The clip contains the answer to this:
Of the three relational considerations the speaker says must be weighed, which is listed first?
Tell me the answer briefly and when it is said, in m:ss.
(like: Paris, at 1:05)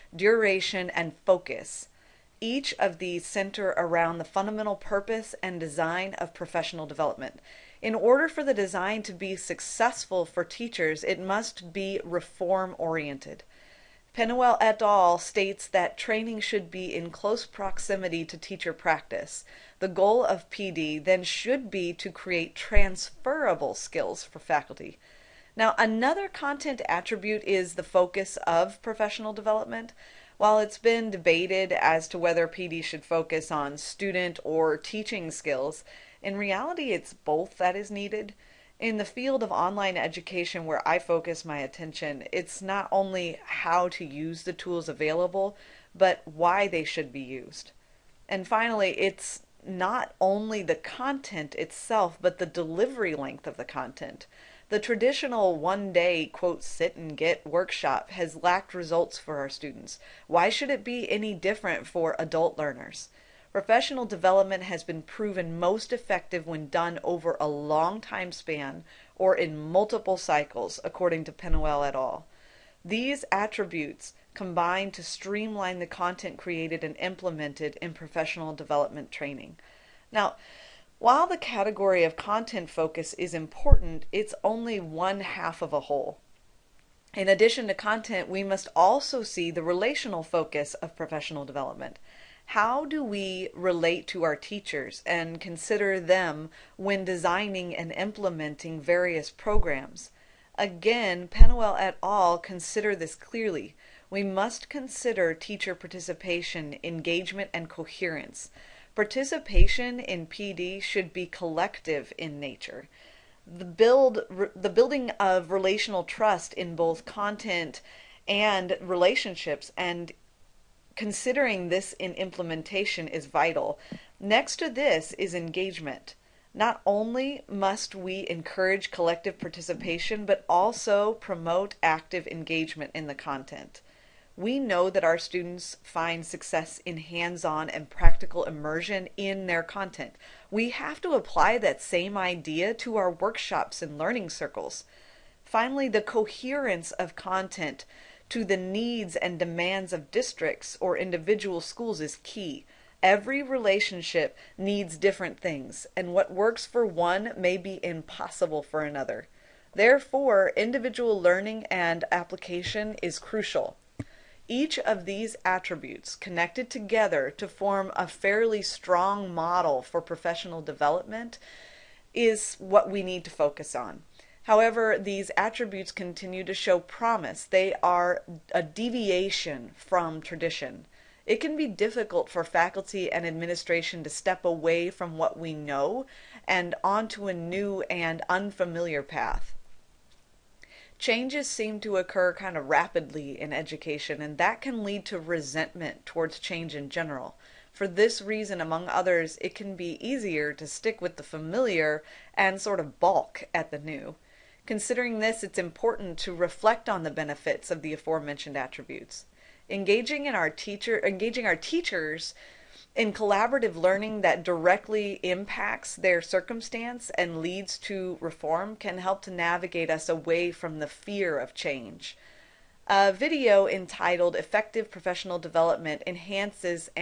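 Teacher participation, at 1:45.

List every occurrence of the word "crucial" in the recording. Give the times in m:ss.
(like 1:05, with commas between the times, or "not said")
2:43.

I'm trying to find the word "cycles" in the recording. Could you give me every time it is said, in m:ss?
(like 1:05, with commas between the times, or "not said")
1:10.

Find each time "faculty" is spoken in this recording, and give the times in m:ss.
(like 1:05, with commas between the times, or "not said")
0:24, 3:02.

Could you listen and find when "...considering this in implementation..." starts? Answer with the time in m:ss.
2:00.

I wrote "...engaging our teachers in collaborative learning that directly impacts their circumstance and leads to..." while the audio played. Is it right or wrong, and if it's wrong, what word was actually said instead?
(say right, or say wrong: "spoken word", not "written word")
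right.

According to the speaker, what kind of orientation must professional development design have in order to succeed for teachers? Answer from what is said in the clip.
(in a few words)
Reform oriented.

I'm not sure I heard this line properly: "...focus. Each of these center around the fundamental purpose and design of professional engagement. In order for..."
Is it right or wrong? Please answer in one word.
wrong.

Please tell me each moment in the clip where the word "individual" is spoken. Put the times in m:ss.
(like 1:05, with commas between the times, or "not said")
2:30, 2:40.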